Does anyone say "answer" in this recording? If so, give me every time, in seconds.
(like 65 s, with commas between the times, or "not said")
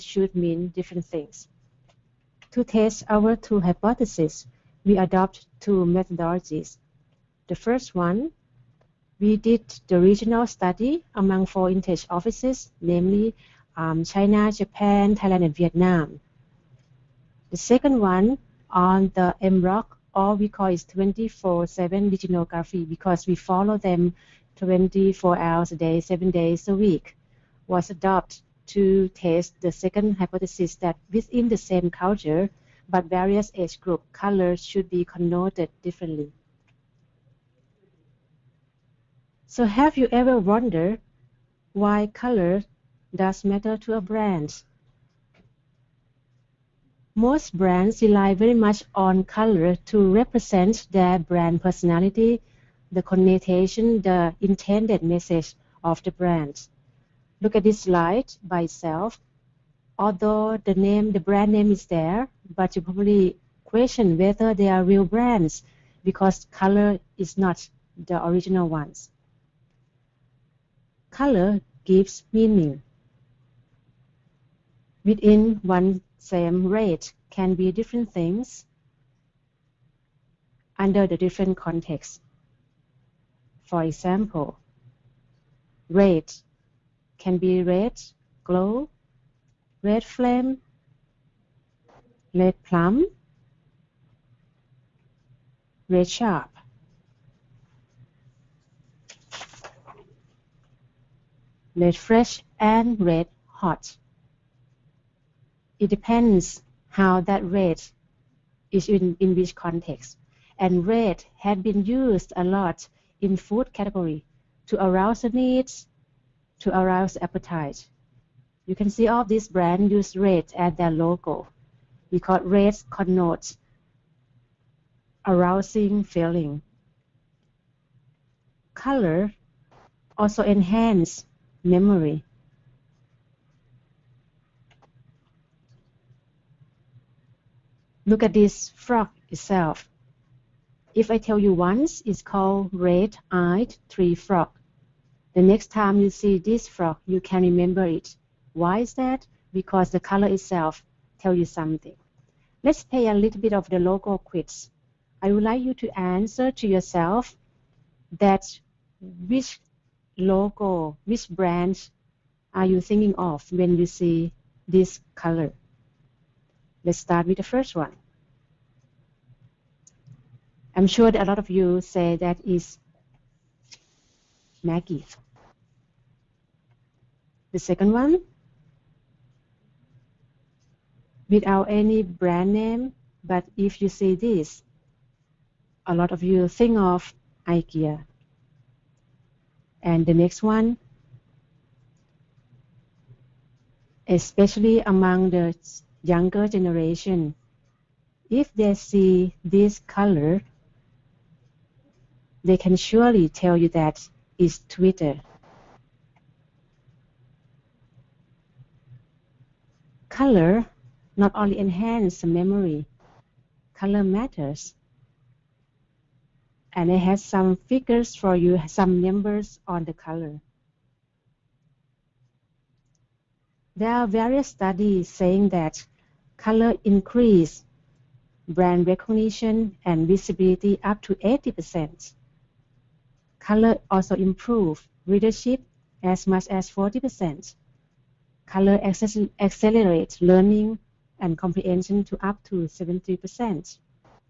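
155 s.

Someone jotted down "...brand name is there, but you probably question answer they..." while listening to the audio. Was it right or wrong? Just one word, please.
wrong.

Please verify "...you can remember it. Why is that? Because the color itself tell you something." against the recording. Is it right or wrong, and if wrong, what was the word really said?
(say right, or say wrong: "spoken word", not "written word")
right.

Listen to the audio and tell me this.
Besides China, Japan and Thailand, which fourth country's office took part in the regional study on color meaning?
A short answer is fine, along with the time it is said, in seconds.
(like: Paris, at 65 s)
Vietnam, at 15 s.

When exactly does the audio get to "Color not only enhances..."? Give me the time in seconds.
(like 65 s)
210 s.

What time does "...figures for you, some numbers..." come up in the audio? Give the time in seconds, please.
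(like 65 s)
217 s.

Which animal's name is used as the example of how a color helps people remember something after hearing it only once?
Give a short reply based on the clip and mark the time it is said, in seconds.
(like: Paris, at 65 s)
Red-eyed tree frog, at 142 s.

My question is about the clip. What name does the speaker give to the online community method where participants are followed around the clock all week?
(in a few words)
24-7 netnography.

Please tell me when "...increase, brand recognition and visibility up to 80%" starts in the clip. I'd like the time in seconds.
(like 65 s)
226 s.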